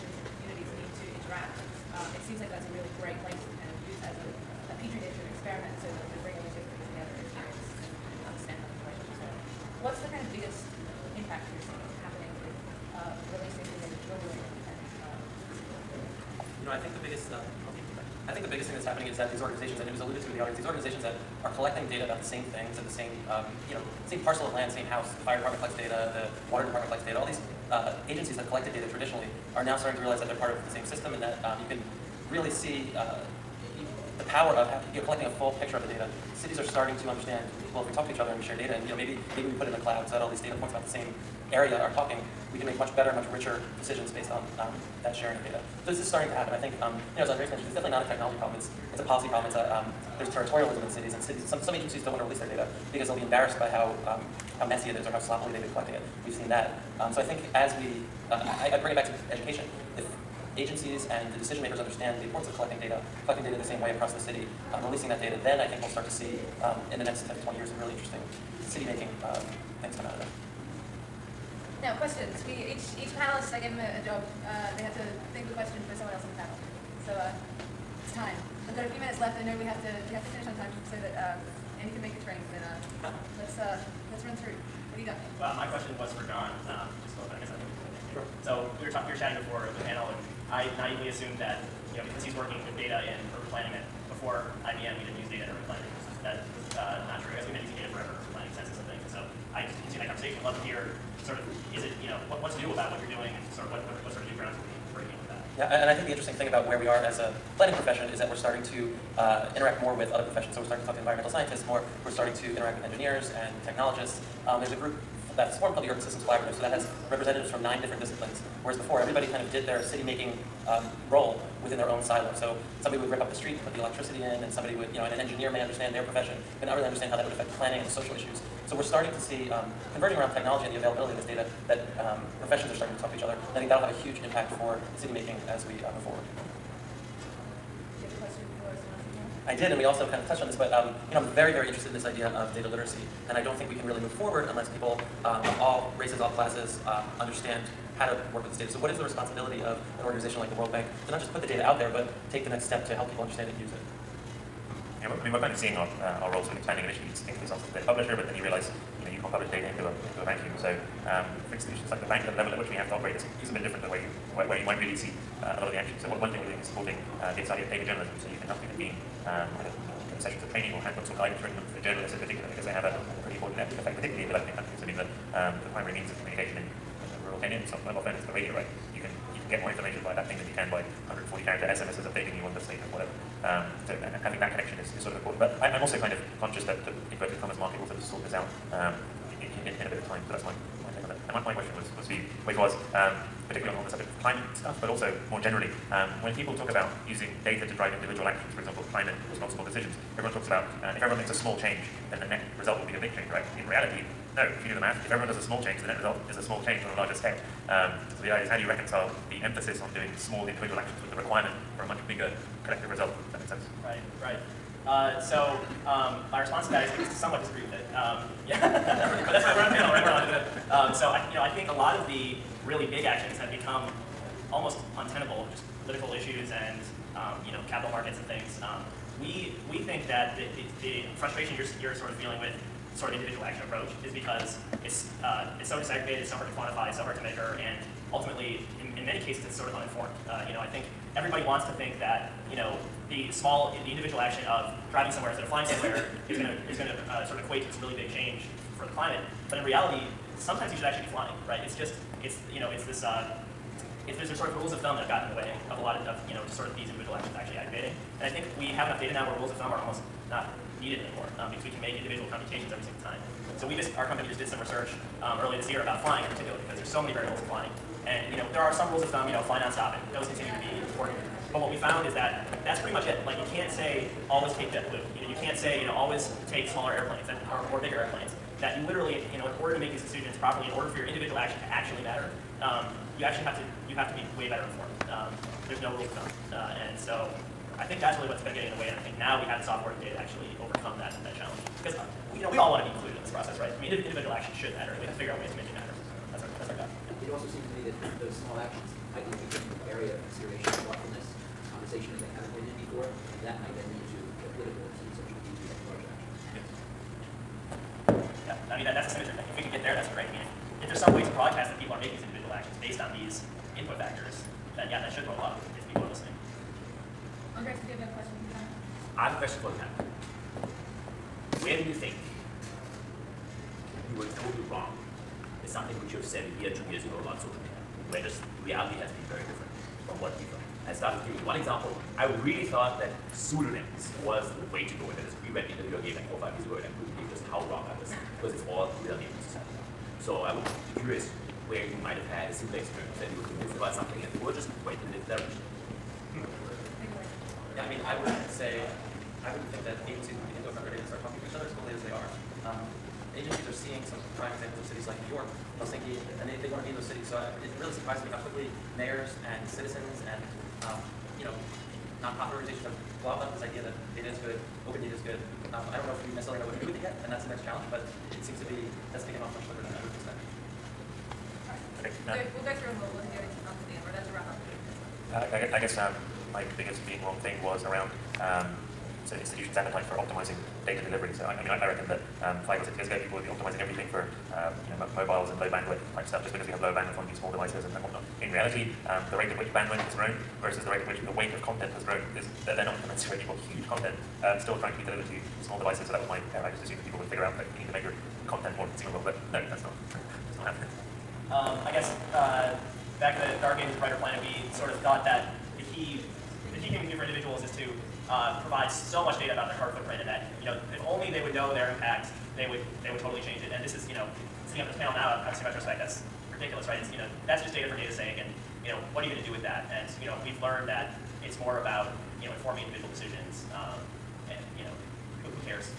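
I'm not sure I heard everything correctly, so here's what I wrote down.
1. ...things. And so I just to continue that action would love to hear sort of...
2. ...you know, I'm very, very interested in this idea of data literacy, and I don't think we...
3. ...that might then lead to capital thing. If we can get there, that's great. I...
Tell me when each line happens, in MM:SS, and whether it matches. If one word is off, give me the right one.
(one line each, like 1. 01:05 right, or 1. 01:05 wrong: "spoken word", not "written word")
1. 01:38 wrong: "conversation", not "action"
2. 02:21 right
3. 05:03 wrong: "political", not "capital".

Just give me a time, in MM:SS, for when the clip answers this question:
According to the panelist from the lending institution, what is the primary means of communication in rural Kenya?
02:58.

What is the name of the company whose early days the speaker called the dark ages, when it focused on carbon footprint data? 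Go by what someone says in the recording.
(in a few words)
Brighter Planet.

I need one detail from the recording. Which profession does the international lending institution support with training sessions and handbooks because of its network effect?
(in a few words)
Journalists.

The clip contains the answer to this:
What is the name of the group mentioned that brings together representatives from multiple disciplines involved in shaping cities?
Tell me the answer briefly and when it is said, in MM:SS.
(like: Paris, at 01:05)
Urban Systems Collaborative, at 01:55.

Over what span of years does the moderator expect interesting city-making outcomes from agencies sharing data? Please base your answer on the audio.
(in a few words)
10 to 20 years.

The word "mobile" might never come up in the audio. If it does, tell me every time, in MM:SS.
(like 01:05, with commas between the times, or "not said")
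02:57, 06:25.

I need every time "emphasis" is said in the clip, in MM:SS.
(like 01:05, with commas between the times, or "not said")
03:29.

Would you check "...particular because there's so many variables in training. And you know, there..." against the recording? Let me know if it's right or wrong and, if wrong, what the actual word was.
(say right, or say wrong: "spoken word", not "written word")
wrong: "flying", not "training".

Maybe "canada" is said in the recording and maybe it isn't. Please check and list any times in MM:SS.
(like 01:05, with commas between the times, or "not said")
not said.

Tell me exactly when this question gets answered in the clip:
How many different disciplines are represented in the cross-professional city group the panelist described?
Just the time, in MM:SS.
01:57.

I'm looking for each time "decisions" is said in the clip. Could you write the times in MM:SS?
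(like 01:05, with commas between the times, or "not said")
00:43, 01:01, 03:19, 04:40, 07:03.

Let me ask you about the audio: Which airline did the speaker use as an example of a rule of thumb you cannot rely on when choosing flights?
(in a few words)
JetBlue.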